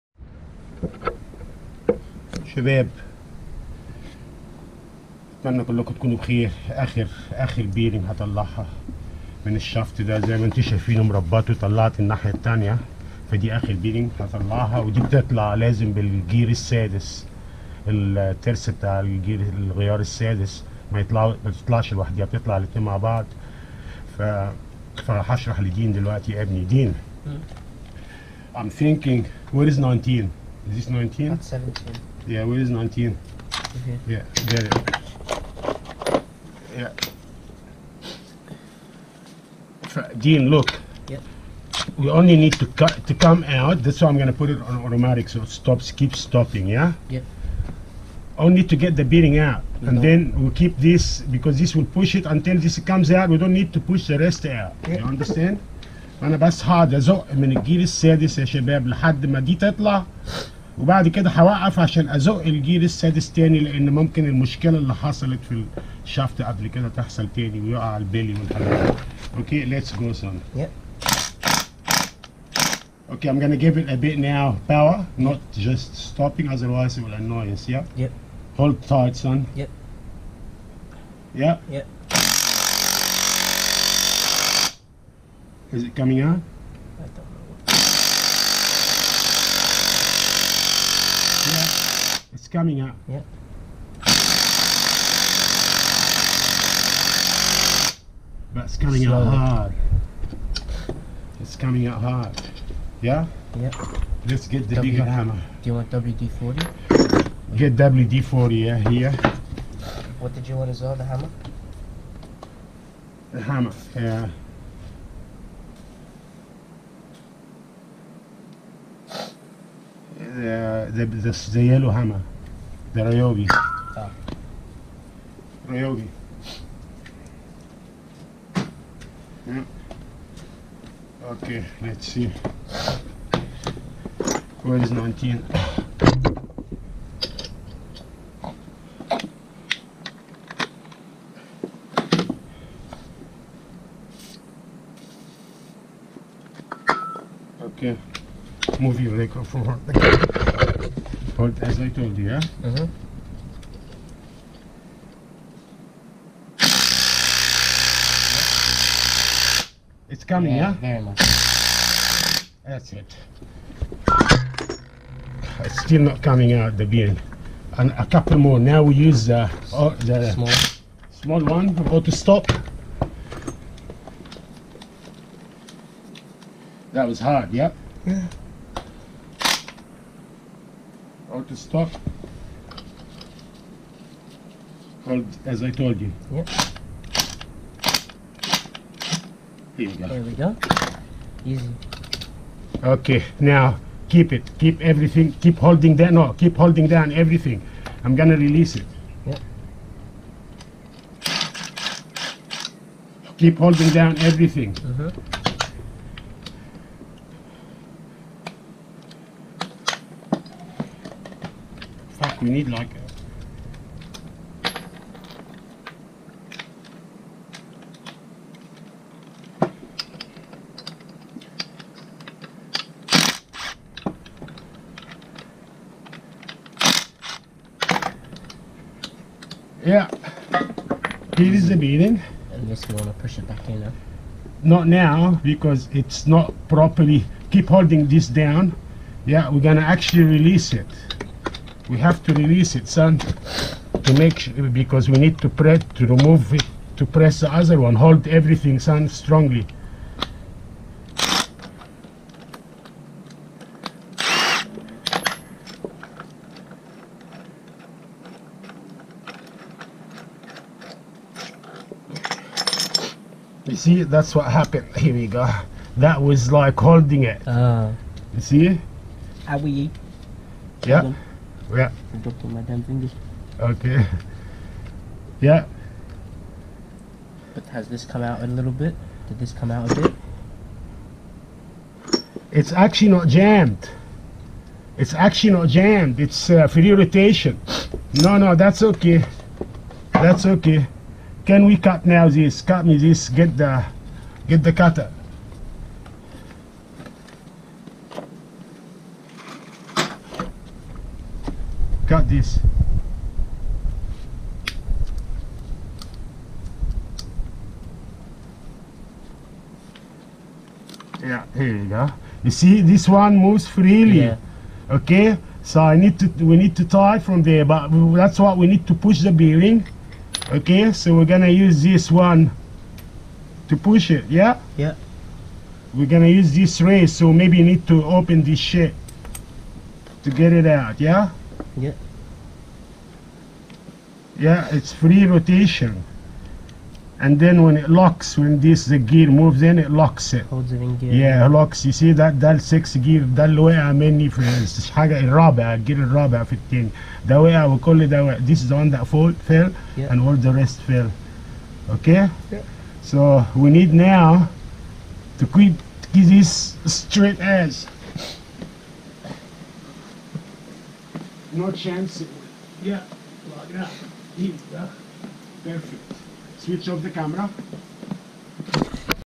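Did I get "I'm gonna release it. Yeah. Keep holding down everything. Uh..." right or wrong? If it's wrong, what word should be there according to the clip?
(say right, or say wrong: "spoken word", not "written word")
right.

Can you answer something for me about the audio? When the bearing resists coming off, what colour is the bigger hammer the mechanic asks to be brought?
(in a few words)
Yellow.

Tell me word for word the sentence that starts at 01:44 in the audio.
Let's get the w bigger hammer.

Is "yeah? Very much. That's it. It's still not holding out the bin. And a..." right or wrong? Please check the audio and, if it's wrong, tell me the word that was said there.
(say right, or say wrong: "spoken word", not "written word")
wrong: "coming", not "holding".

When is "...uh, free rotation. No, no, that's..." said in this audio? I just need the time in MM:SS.
04:46.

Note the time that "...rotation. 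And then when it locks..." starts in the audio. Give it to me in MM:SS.
05:35.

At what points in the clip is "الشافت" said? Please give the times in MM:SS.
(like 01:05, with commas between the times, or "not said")
00:09, 01:06.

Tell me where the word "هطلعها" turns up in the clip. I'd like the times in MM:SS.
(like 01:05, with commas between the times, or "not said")
00:08, 00:14.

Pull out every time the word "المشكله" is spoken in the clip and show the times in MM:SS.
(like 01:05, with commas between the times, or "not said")
01:04.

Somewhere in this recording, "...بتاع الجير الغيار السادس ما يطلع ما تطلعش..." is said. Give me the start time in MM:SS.
00:18.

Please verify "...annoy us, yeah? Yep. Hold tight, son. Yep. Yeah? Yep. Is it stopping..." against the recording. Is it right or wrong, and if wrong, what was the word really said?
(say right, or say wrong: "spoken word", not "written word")
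wrong: "coming", not "stopping".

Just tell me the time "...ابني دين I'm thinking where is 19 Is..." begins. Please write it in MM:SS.
00:26.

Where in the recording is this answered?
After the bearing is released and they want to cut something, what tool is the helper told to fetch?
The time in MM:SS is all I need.
04:54.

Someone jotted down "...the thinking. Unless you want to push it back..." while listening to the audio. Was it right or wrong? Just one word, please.
wrong.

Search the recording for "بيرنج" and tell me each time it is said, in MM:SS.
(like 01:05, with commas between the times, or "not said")
00:07, 00:13.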